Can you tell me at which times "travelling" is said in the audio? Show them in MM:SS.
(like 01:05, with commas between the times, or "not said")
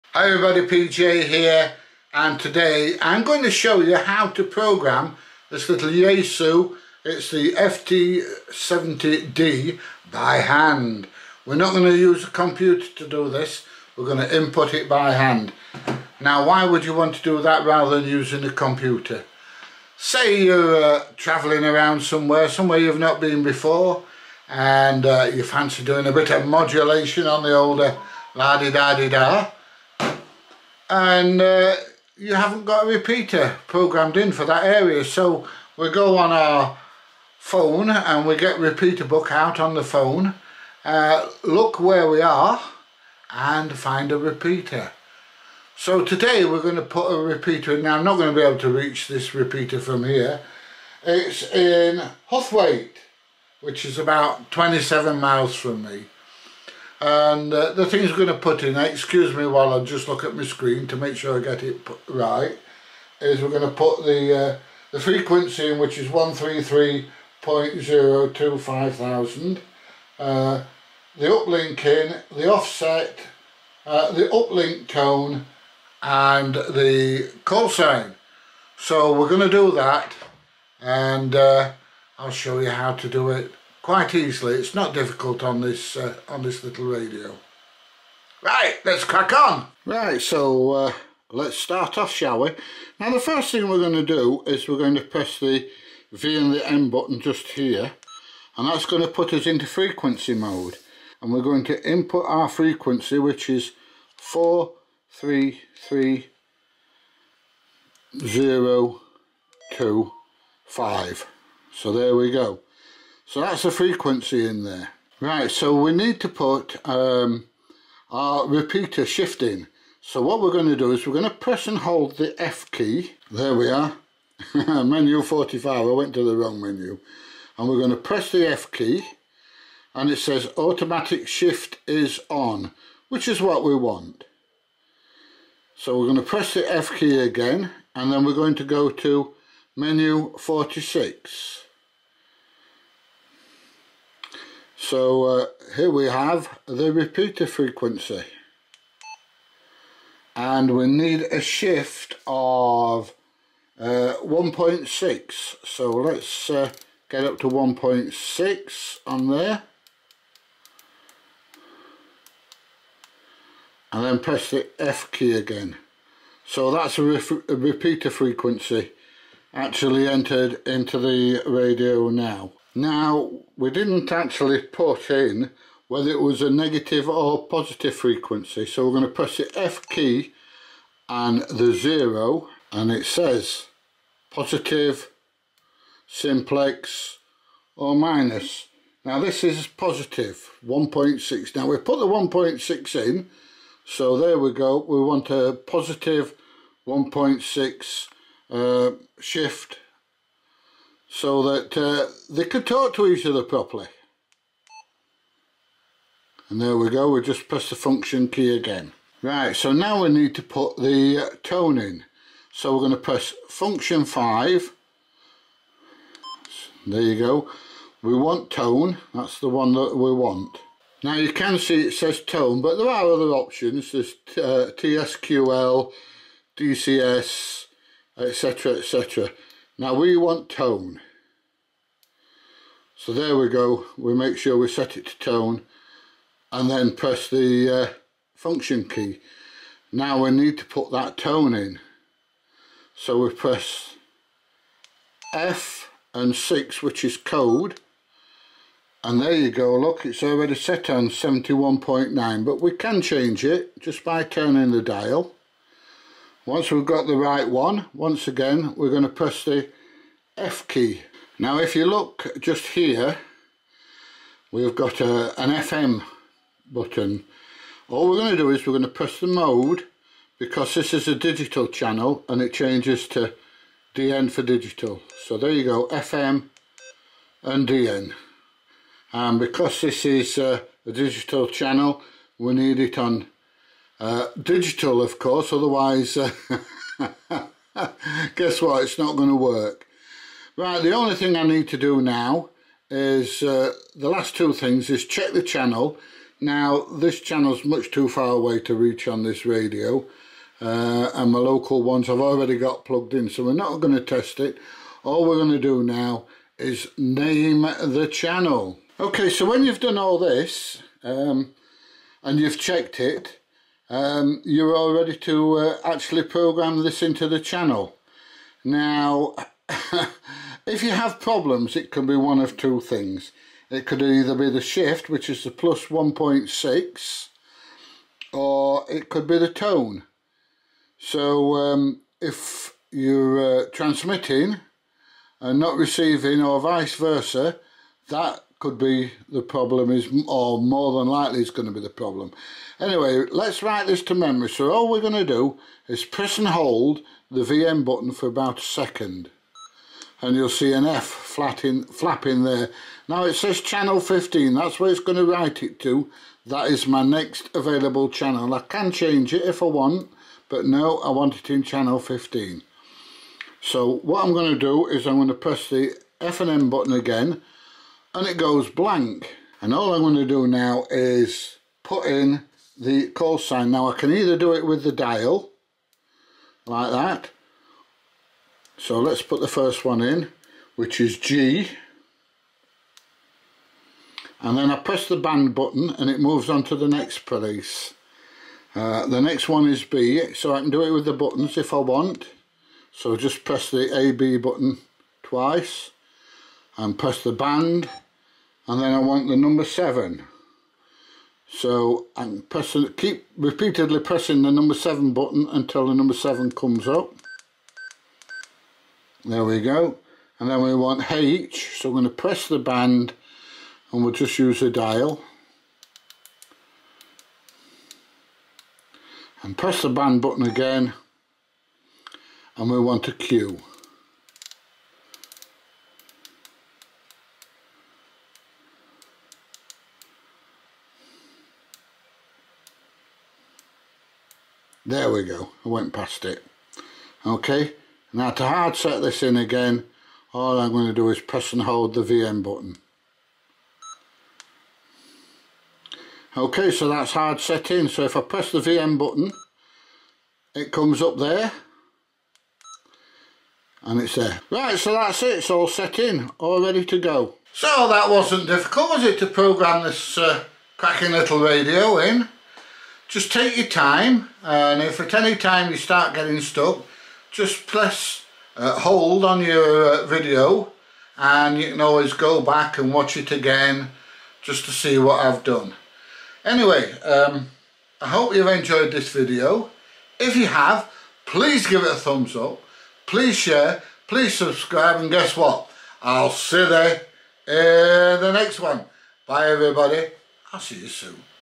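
00:21.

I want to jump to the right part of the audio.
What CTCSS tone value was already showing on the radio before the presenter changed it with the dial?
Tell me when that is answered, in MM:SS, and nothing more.
04:11.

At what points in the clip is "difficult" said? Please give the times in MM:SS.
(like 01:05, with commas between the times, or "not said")
01:24, 07:38.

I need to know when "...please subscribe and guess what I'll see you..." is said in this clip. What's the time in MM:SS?
08:04.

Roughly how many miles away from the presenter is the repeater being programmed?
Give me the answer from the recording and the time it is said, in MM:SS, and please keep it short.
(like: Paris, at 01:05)
27 miles, at 00:54.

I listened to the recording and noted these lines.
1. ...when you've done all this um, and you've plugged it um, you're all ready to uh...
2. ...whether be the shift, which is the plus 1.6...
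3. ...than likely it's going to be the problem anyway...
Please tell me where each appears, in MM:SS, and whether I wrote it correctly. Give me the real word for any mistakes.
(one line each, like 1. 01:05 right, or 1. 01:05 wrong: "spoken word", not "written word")
1. 05:09 wrong: "checked", not "plugged"
2. 05:24 wrong: "either", not "whether"
3. 05:40 right.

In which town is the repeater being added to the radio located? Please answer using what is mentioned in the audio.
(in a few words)
Huthwaite.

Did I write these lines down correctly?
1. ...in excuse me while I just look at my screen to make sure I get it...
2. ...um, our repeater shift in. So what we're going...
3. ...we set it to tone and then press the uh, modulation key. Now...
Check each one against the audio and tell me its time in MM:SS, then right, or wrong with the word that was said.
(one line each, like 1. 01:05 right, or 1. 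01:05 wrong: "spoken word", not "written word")
1. 00:58 right
2. 01:56 right
3. 03:54 wrong: "function", not "modulation".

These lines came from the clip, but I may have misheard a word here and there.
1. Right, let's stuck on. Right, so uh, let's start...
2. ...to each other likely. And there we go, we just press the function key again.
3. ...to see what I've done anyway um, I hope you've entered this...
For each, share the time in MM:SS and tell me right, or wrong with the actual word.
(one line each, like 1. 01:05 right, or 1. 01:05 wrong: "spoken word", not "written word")
1. 01:28 wrong: "crack", not "stuck"
2. 03:22 wrong: "properly", not "likely"
3. 07:54 wrong: "enjoyed", not "entered".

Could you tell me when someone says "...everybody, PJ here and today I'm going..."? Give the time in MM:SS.
00:00.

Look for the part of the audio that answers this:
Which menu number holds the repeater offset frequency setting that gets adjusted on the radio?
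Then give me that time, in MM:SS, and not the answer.
02:19.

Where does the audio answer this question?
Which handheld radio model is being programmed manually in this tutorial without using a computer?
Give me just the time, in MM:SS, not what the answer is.
00:07.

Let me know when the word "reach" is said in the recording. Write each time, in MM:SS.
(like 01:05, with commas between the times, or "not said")
00:48, 04:58.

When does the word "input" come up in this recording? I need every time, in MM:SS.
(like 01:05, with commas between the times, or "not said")
00:14, 01:41.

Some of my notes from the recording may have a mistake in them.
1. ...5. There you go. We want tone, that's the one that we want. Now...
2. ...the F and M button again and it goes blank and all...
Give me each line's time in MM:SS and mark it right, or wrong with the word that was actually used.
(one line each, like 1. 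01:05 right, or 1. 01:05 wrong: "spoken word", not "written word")
1. 03:34 right
2. 06:05 right.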